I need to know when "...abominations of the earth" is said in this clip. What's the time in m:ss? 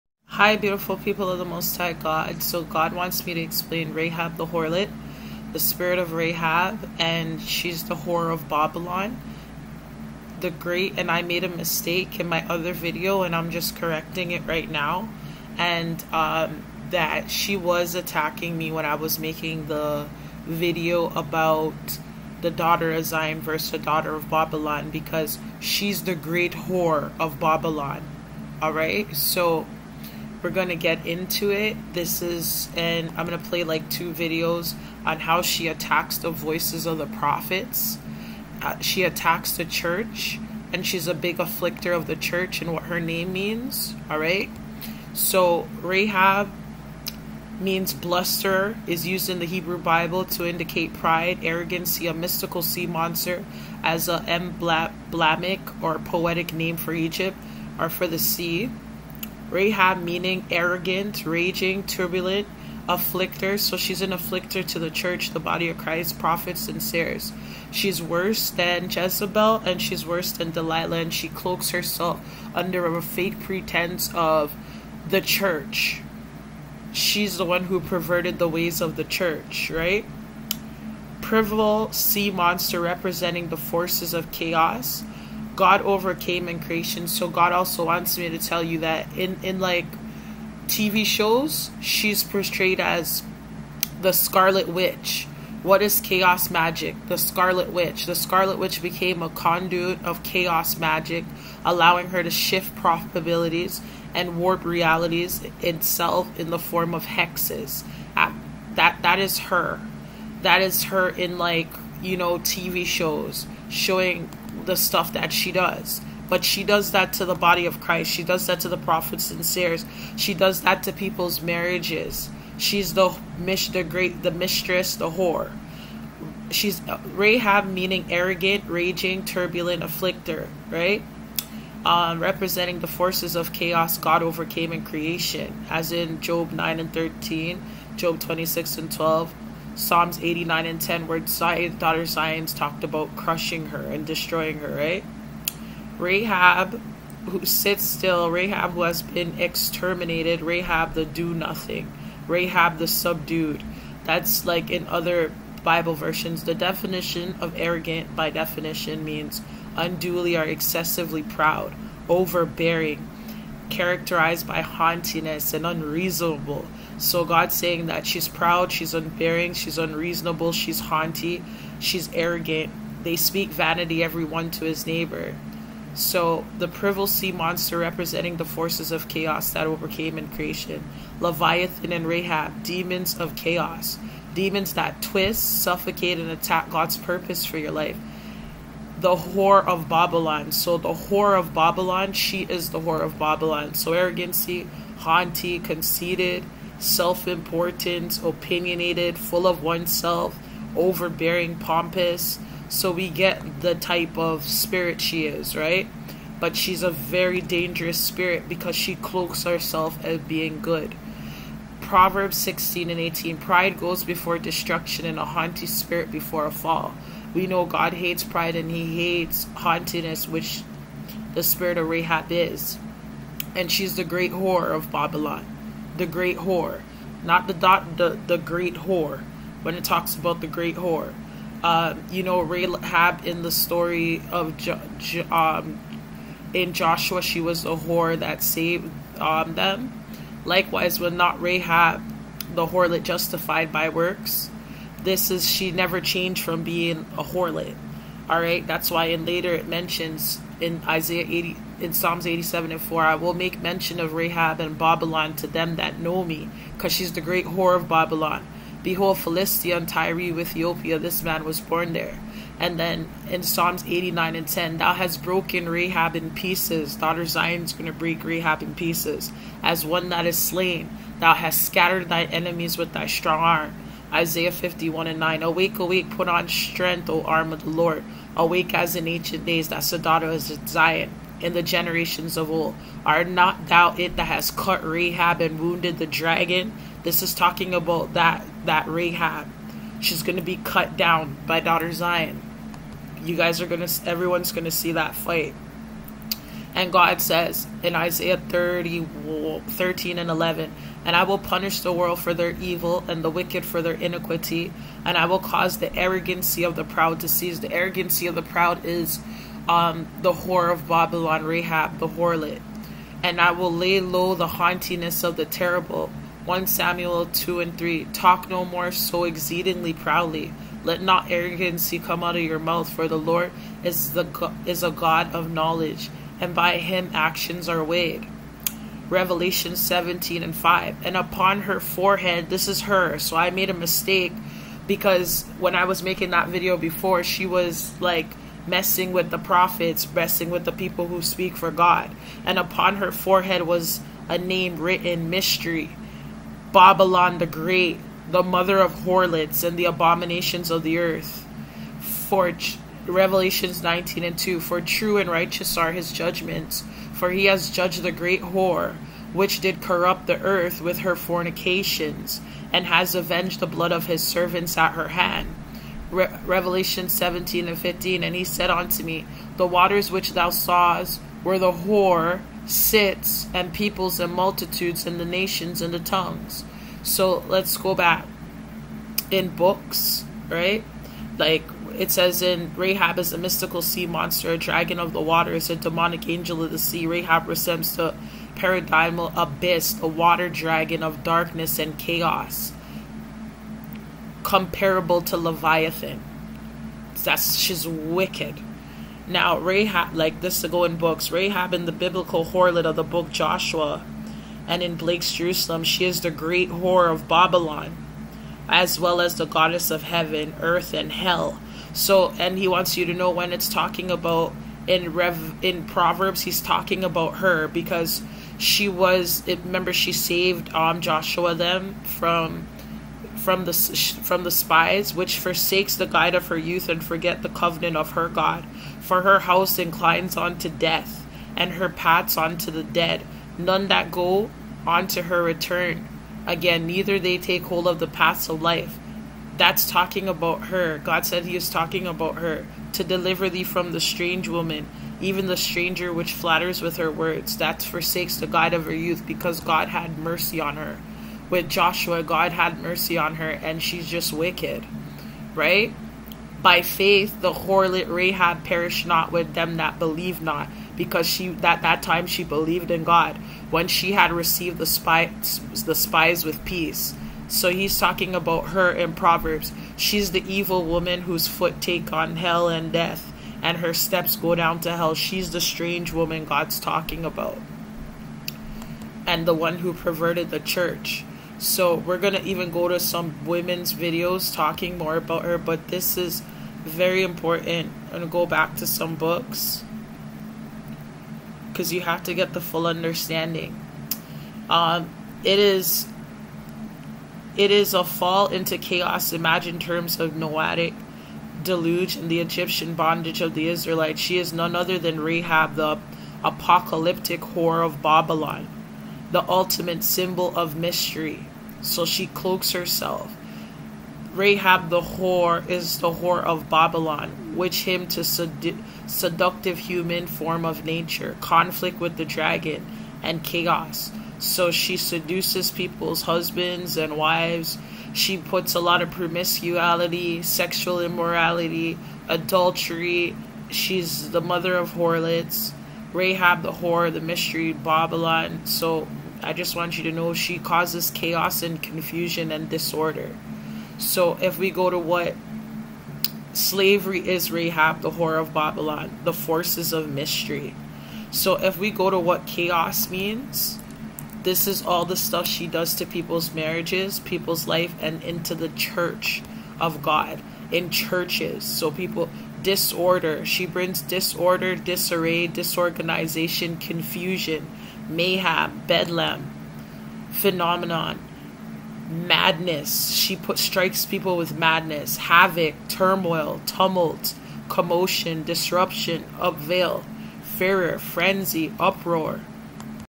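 5:49.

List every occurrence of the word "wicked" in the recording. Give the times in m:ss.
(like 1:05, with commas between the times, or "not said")
5:03, 6:37, 7:34.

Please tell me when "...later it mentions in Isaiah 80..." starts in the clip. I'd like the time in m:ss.
4:09.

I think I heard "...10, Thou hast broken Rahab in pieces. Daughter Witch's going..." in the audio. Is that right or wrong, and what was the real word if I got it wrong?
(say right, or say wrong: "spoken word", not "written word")
wrong: "Zion", not "Witch".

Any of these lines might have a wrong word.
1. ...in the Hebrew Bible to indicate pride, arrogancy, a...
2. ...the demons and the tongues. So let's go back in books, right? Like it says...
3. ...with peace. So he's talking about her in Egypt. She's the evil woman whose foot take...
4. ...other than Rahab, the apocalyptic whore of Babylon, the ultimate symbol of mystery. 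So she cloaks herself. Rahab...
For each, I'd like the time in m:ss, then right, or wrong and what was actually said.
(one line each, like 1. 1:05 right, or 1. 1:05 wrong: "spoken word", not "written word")
1. 0:49 right
2. 6:15 wrong: "nations", not "demons"
3. 7:46 wrong: "Proverbs", not "Egypt"
4. 8:24 right.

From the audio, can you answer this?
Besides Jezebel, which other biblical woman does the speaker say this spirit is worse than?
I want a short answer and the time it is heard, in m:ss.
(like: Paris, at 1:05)
Delilah, at 1:10.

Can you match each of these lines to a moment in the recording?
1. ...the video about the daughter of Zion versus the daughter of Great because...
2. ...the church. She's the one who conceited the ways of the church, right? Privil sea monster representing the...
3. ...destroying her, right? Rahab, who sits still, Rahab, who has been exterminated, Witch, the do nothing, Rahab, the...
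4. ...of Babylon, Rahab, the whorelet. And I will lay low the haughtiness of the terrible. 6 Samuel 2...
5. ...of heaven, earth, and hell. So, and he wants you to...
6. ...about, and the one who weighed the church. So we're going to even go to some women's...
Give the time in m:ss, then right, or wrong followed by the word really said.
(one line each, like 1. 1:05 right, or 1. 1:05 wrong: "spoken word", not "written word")
1. 0:19 wrong: "Babylon", not "Great"
2. 1:15 wrong: "perverted", not "conceited"
3. 2:24 wrong: "Rahab", not "Witch"
4. 5:10 wrong: "1", not "6"
5. 6:49 right
6. 7:57 wrong: "perverted", not "weighed".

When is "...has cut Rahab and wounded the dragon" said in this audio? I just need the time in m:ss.
4:44.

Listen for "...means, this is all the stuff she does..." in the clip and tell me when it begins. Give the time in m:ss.
9:13.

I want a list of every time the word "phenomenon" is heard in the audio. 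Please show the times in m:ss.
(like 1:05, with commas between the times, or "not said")
9:30.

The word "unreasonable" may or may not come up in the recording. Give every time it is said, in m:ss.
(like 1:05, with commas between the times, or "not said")
2:45, 2:49.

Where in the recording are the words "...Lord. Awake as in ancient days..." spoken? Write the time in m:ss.
4:37.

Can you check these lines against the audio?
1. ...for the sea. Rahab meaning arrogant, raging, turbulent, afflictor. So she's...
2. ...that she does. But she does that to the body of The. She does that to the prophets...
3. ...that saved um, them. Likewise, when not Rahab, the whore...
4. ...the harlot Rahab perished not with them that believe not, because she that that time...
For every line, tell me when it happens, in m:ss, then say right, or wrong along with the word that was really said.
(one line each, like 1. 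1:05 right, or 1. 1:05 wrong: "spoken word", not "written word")
1. 0:57 right
2. 1:55 wrong: "Christ", not "The"
3. 3:58 right
4. 7:37 right.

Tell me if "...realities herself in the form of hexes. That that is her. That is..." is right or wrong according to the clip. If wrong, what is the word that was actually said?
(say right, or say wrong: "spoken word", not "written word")
wrong: "itself", not "herself".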